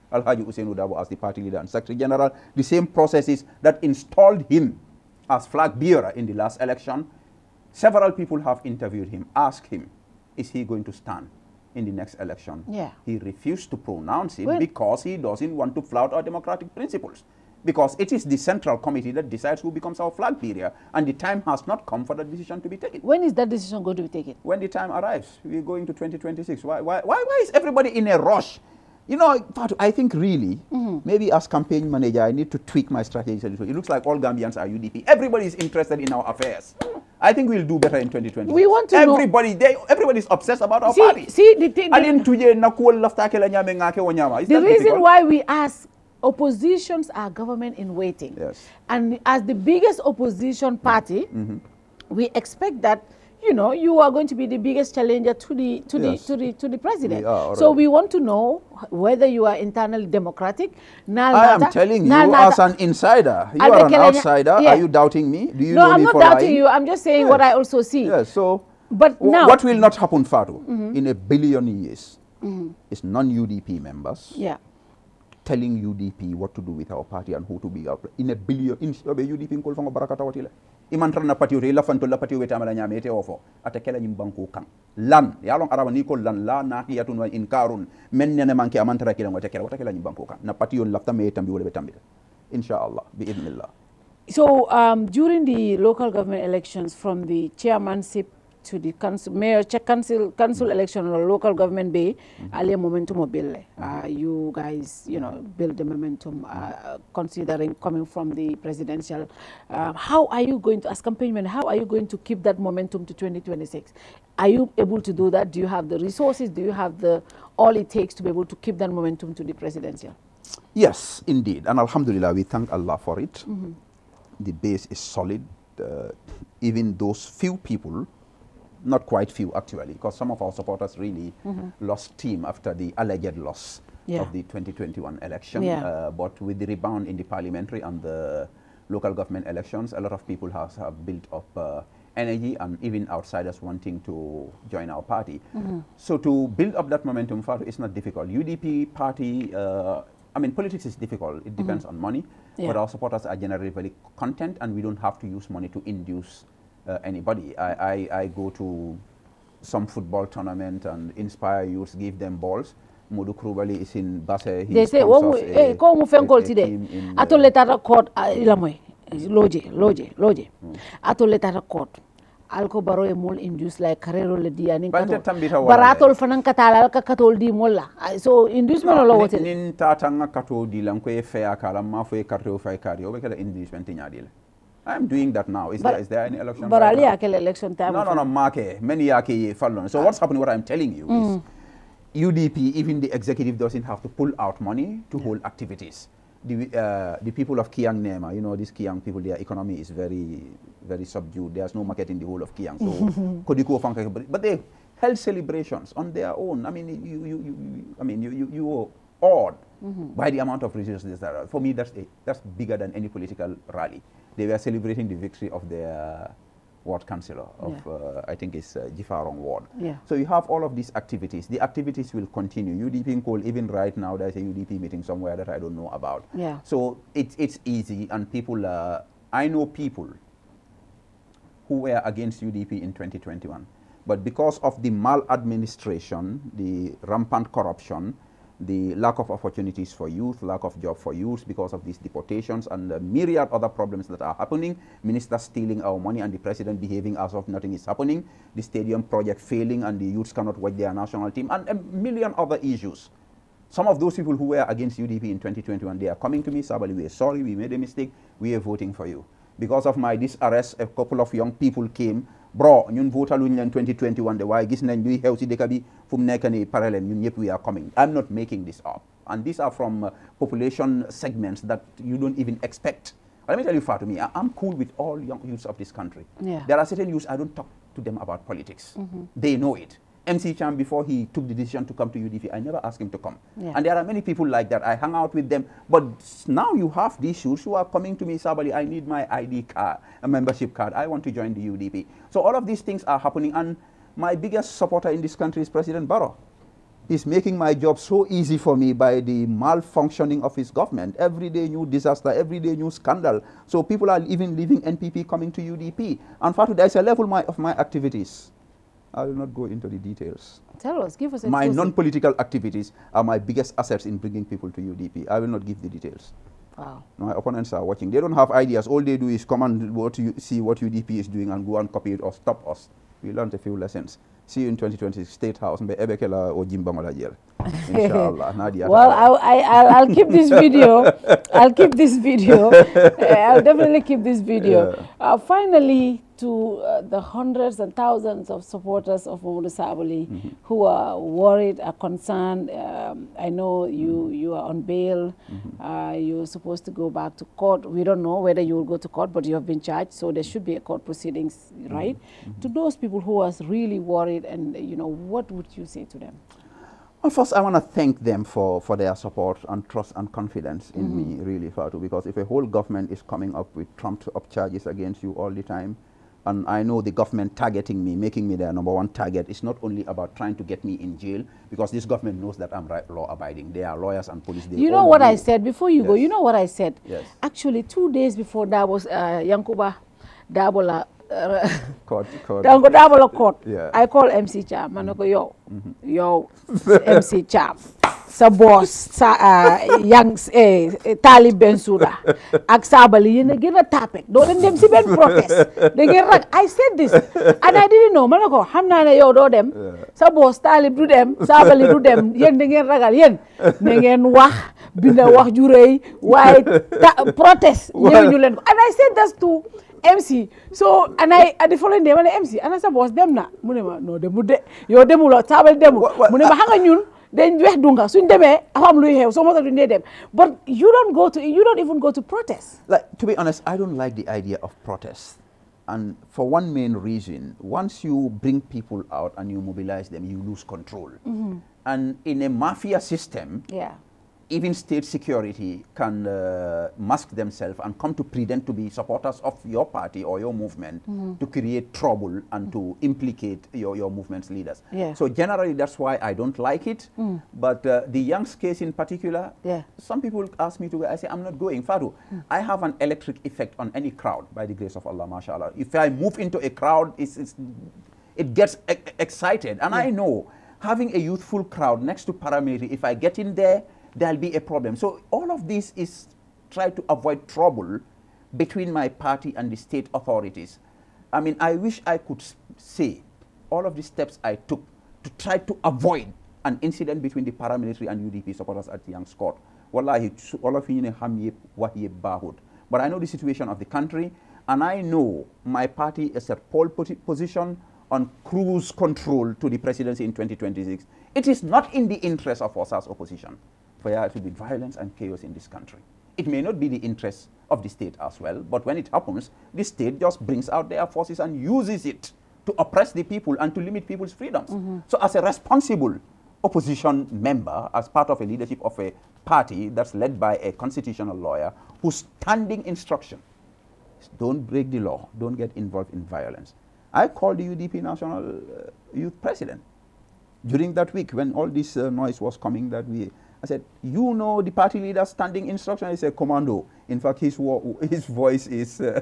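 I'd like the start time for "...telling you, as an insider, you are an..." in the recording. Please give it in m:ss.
1:01.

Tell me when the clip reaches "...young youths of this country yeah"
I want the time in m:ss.
4:35.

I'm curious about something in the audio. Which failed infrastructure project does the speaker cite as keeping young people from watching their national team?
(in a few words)
stadium project.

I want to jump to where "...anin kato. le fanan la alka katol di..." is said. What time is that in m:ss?
2:54.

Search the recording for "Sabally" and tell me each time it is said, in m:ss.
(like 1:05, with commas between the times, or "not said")
4:16, 4:48, 5:39, 6:32, 6:41.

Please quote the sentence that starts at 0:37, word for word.
I think we'll do better in 2020.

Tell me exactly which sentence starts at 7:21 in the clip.
to create trouble and mm -hmm.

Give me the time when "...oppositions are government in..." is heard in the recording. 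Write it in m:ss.
0:46.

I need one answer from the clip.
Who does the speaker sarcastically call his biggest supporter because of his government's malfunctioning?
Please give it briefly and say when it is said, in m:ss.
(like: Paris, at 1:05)
President Barrow, at 4:55.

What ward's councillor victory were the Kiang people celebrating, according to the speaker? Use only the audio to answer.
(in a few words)
Jifarong.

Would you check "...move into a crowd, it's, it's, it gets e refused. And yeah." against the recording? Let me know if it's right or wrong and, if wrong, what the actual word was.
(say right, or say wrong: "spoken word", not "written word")
wrong: "excited", not "refused".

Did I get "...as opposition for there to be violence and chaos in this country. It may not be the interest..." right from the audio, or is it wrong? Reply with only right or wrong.
right.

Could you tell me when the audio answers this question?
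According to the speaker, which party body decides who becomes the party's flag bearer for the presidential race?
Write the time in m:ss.
0:18.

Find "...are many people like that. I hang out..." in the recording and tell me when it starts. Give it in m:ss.
4:43.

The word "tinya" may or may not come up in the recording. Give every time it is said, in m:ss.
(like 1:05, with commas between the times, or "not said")
3:03.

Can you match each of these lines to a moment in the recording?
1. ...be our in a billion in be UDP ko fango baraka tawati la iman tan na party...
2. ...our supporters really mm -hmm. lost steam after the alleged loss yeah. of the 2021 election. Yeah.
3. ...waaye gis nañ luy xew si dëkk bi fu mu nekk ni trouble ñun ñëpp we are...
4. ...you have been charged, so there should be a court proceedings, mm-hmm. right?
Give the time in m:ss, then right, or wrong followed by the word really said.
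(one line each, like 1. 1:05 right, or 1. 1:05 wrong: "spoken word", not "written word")
1. 1:17 right
2. 2:10 right
3. 4:24 wrong: "parallèle", not "trouble"
4. 5:49 right.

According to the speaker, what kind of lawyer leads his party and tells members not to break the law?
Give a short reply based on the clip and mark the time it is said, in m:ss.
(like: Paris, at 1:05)
constitutional lawyer, at 8:30.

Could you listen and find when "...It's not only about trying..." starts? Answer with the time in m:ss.
6:09.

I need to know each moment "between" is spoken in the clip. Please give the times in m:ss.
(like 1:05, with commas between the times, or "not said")
7:48, 7:57.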